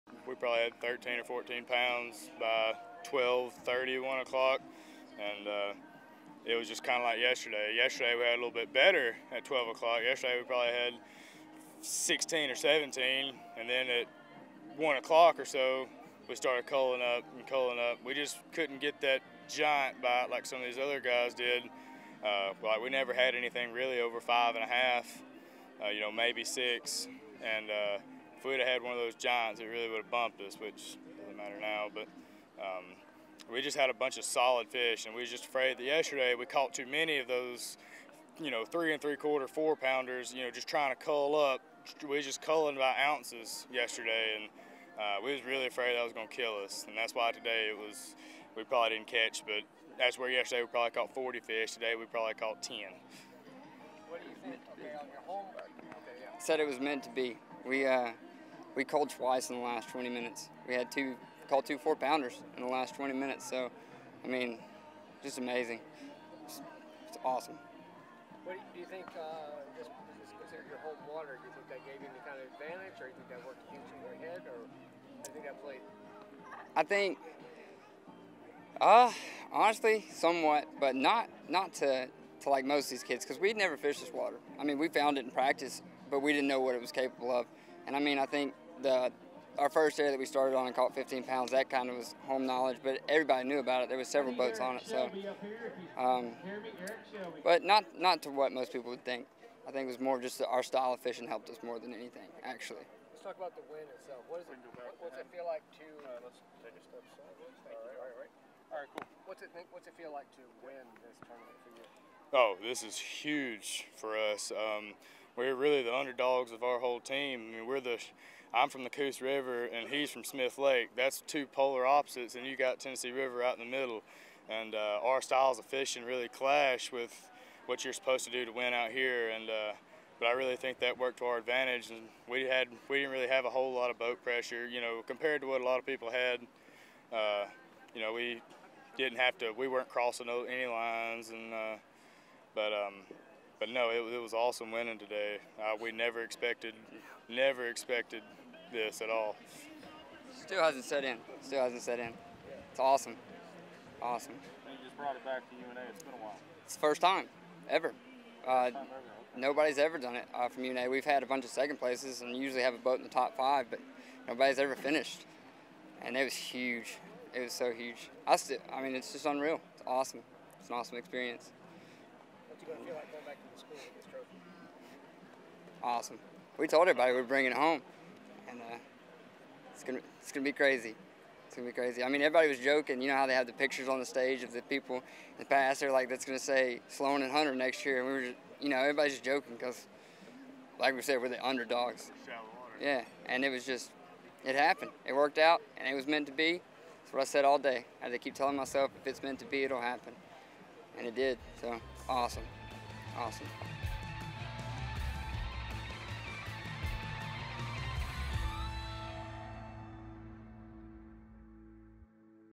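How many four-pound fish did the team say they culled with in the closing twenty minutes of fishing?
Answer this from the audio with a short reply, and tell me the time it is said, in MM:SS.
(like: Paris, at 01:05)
2, at 01:01.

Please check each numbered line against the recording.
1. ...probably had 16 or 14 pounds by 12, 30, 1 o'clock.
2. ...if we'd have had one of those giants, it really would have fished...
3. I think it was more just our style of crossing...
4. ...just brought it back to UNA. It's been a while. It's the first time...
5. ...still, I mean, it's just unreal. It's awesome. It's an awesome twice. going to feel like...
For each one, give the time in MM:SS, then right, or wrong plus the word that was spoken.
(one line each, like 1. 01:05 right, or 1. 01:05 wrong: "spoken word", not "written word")
1. 00:00 wrong: "13", not "16"
2. 00:28 wrong: "bumped", not "fished"
3. 01:39 wrong: "fishing", not "crossing"
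4. 02:34 right
5. 02:48 wrong: "experience", not "twice".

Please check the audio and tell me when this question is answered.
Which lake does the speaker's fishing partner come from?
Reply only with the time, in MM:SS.
02:00.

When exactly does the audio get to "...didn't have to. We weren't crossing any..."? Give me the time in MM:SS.
02:18.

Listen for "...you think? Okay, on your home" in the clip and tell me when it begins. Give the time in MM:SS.
00:54.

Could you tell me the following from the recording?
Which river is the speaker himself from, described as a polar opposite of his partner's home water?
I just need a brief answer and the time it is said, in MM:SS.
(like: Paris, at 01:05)
Coosa River, at 01:58.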